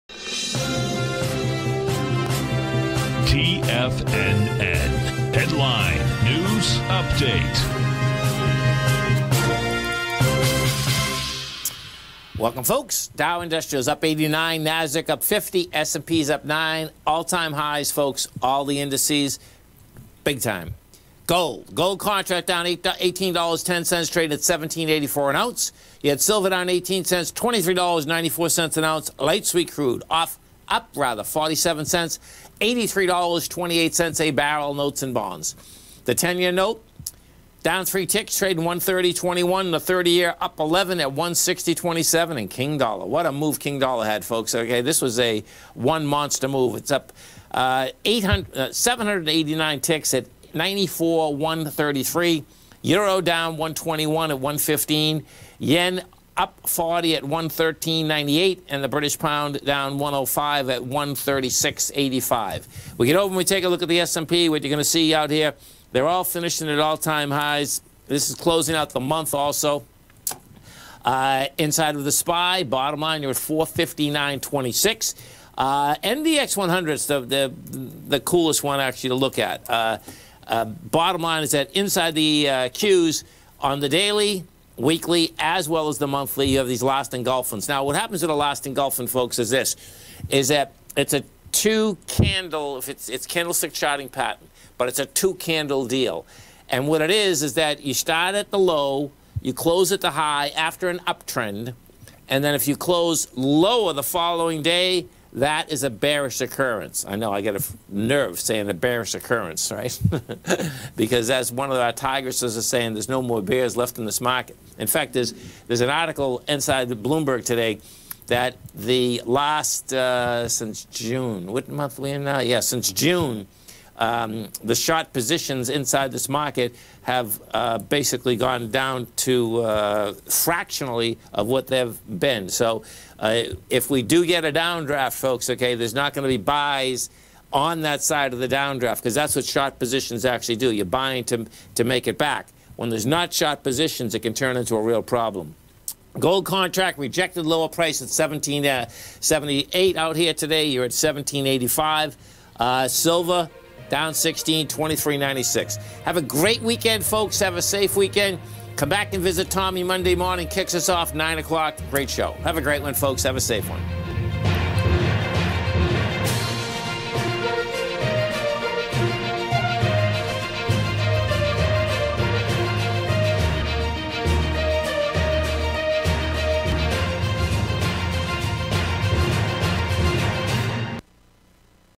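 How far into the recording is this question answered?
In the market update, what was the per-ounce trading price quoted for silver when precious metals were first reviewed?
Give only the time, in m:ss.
0:27.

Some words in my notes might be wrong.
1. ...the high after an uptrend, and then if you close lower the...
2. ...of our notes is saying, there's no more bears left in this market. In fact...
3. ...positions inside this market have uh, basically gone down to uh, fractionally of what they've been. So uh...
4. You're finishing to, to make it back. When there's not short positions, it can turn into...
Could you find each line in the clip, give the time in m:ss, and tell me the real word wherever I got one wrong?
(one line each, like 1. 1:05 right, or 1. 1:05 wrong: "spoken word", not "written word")
1. 1:39 right
2. 1:51 wrong: "tigresses", not "notes"
3. 2:05 right
4. 2:20 wrong: "buying", not "finishing".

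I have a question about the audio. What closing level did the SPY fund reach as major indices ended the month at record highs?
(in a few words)
459.26.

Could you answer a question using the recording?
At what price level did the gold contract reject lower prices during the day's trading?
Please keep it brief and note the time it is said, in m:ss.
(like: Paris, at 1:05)
1778, at 2:28.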